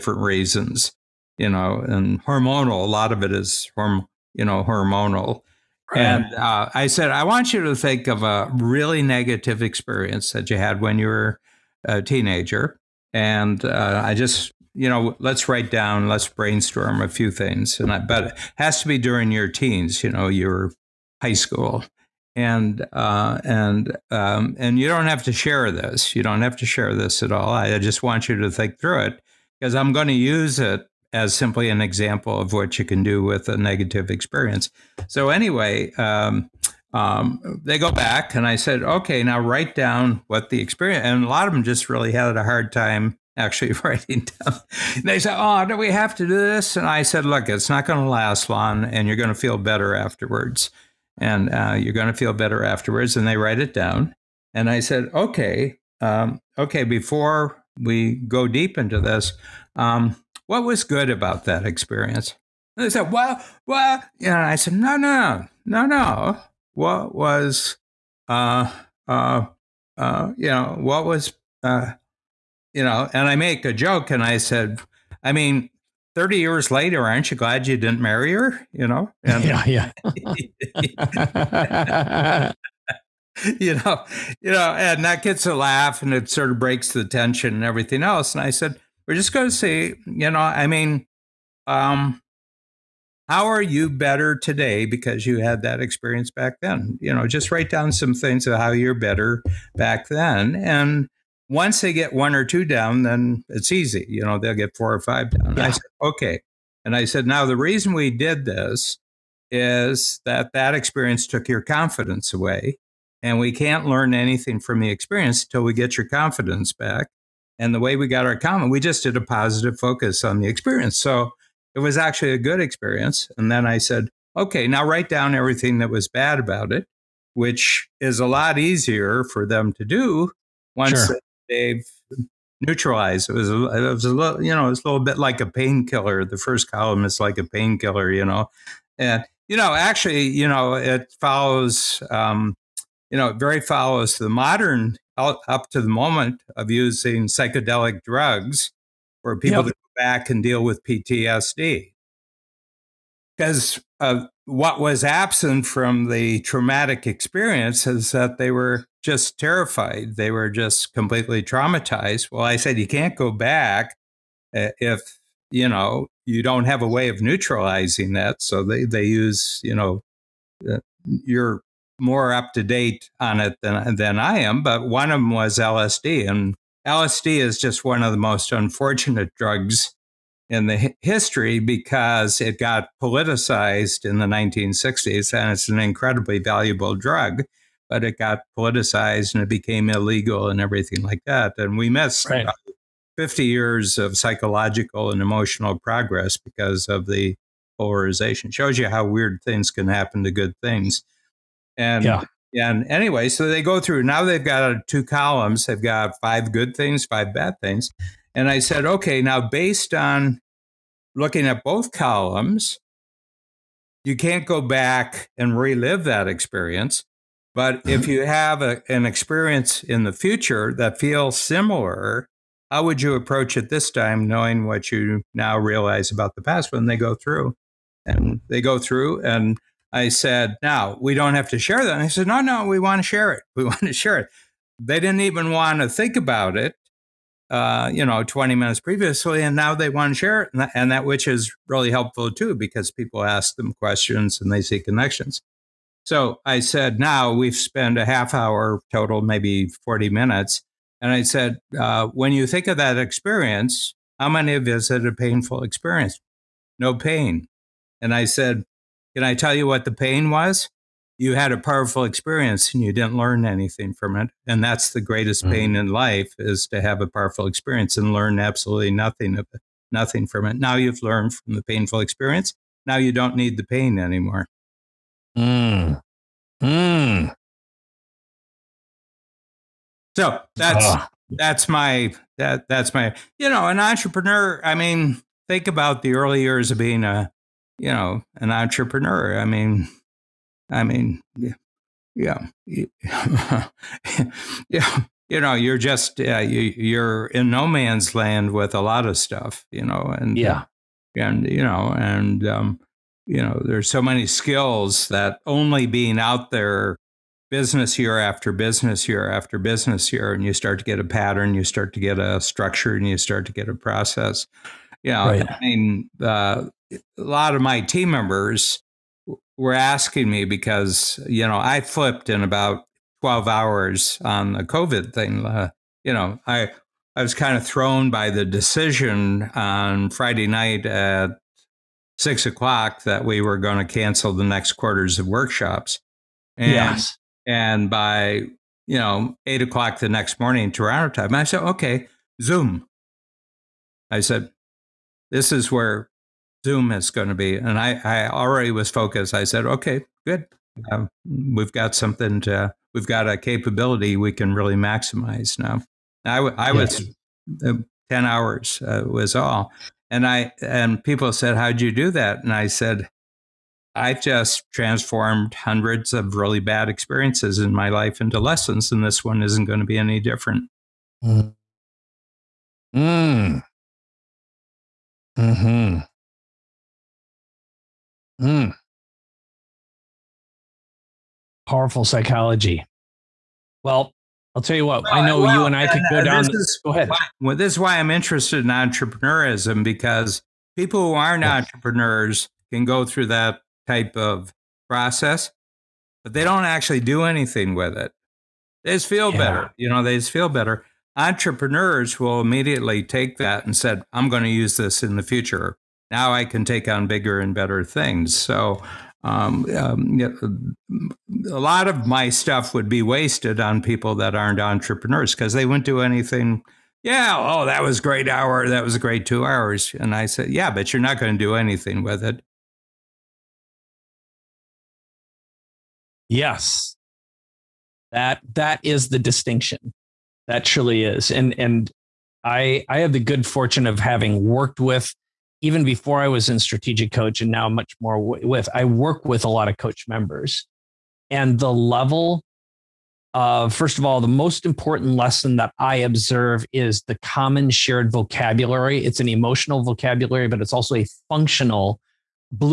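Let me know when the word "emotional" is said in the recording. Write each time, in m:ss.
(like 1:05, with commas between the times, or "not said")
3:15, 7:29.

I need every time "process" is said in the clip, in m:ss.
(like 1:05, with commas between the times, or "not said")
5:13, 6:34.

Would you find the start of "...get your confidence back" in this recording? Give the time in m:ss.
1:55.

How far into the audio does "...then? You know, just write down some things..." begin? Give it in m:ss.
1:36.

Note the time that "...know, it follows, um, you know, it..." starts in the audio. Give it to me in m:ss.
2:20.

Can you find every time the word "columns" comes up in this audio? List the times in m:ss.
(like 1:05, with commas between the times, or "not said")
2:16, 3:25, 3:31.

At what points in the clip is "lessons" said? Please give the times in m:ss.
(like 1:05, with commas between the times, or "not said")
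6:08, 7:25.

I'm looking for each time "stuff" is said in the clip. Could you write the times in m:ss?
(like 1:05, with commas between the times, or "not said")
4:59, 6:52.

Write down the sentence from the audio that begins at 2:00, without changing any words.
So it was actually a good experience.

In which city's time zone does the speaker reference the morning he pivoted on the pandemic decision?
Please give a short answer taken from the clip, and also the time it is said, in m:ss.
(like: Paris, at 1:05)
Toronto, at 5:40.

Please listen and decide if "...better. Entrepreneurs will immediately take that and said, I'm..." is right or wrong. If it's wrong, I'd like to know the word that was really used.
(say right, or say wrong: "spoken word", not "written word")
right.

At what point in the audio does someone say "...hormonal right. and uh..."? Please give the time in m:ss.
0:04.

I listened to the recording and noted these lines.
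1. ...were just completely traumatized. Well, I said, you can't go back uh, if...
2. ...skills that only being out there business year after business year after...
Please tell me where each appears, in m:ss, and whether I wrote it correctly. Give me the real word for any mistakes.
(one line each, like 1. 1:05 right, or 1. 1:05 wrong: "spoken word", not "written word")
1. 2:40 right
2. 5:04 right.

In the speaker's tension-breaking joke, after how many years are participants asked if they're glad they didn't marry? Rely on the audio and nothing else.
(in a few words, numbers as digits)
30.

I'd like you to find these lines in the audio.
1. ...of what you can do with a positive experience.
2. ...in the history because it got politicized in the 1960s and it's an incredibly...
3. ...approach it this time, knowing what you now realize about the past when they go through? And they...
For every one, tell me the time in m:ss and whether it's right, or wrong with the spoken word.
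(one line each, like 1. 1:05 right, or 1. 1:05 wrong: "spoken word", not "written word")
1. 0:32 wrong: "negative", not "positive"
2. 3:00 right
3. 3:43 right.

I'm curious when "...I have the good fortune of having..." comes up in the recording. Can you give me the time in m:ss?
7:12.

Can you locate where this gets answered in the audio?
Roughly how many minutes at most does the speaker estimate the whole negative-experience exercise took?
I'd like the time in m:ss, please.
4:09.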